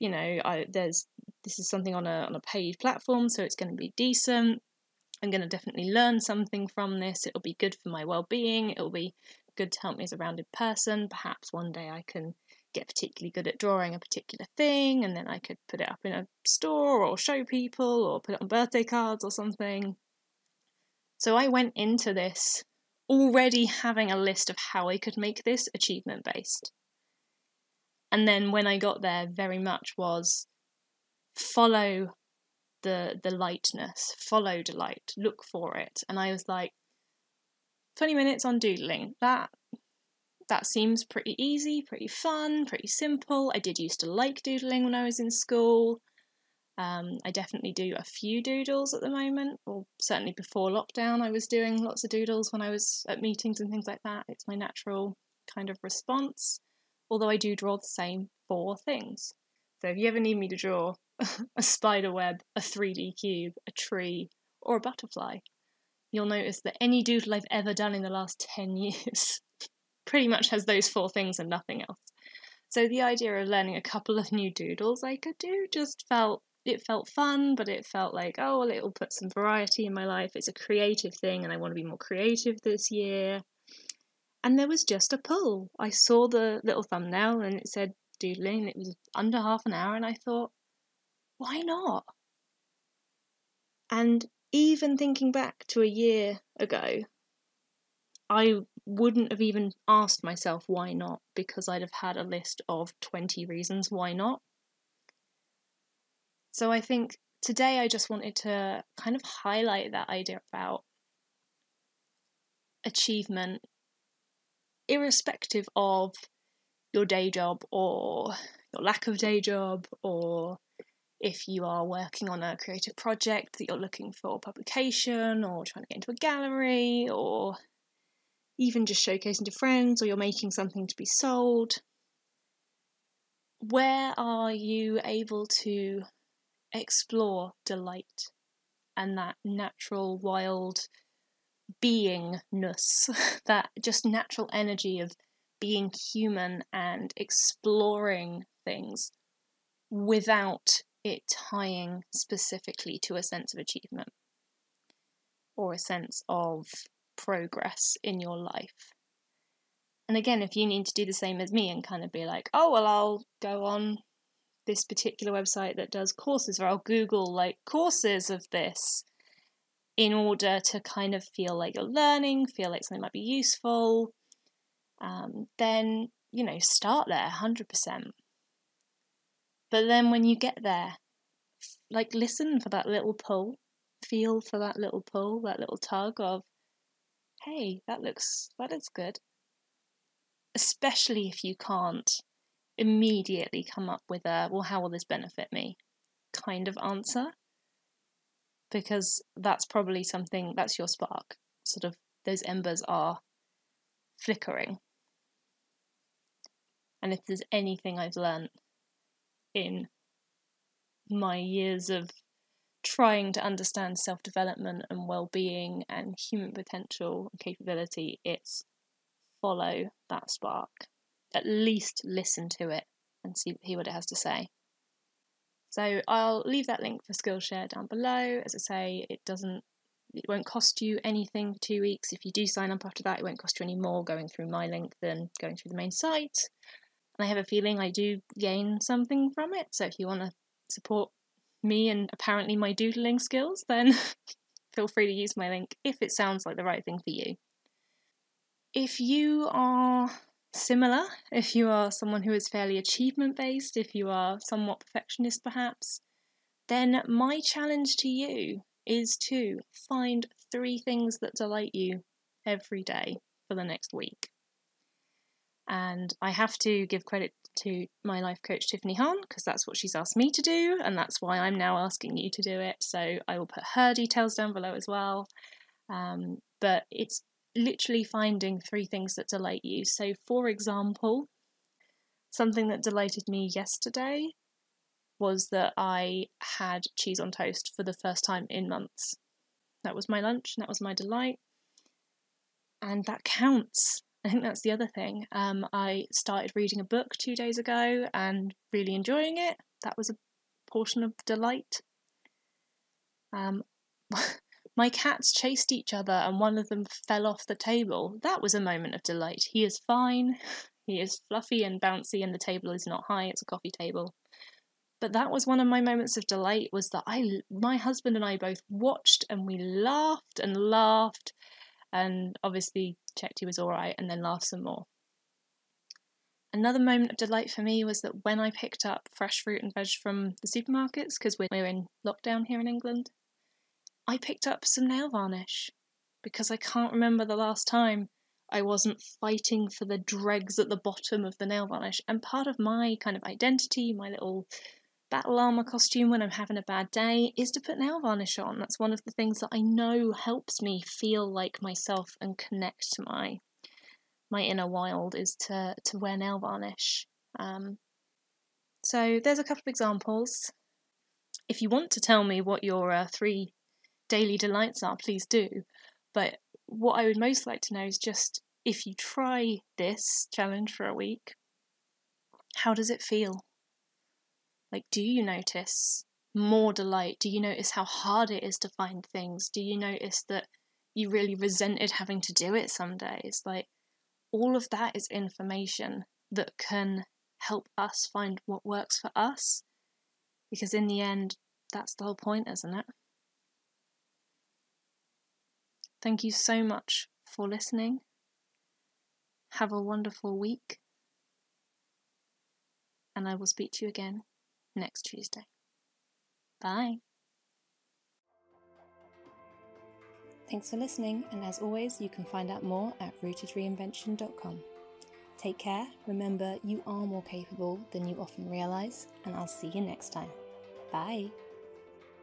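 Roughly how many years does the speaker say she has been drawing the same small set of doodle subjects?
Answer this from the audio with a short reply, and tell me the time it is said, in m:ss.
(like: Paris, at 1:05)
10, at 1:08.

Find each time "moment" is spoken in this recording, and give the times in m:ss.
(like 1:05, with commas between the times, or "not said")
0:49, 5:08, 5:15, 5:26.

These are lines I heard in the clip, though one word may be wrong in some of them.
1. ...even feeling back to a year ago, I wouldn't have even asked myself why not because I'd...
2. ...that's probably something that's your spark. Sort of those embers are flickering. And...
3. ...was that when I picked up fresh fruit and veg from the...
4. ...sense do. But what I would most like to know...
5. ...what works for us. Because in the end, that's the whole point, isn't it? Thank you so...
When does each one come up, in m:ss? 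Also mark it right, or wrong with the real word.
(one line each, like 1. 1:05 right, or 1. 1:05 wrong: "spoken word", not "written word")
1. 1:34 wrong: "thinking", not "feeling"
2. 3:19 right
3. 5:27 right
4. 6:04 wrong: "please", not "sense"
5. 6:28 right.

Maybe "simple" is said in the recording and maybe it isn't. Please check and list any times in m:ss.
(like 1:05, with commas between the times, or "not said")
0:42.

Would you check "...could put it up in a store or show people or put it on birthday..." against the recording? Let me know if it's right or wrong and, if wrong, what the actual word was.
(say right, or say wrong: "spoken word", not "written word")
right.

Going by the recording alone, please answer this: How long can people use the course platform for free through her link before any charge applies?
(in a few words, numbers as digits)
two weeks.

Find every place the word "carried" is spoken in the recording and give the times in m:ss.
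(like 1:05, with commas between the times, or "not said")
not said.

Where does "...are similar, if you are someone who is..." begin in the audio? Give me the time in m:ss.
4:09.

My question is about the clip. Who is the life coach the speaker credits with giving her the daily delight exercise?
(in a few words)
Tiffany Hahn.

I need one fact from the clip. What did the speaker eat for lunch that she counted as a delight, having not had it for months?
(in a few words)
cheese on toast.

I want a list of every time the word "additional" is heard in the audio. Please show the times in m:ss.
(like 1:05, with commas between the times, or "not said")
not said.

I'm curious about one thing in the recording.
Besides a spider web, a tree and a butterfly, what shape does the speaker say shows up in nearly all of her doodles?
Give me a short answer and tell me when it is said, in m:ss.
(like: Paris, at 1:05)
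3D cube, at 1:02.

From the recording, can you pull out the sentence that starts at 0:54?
It's my natural kind of response, although I do draw the same four things.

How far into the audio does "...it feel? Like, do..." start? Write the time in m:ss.
6:12.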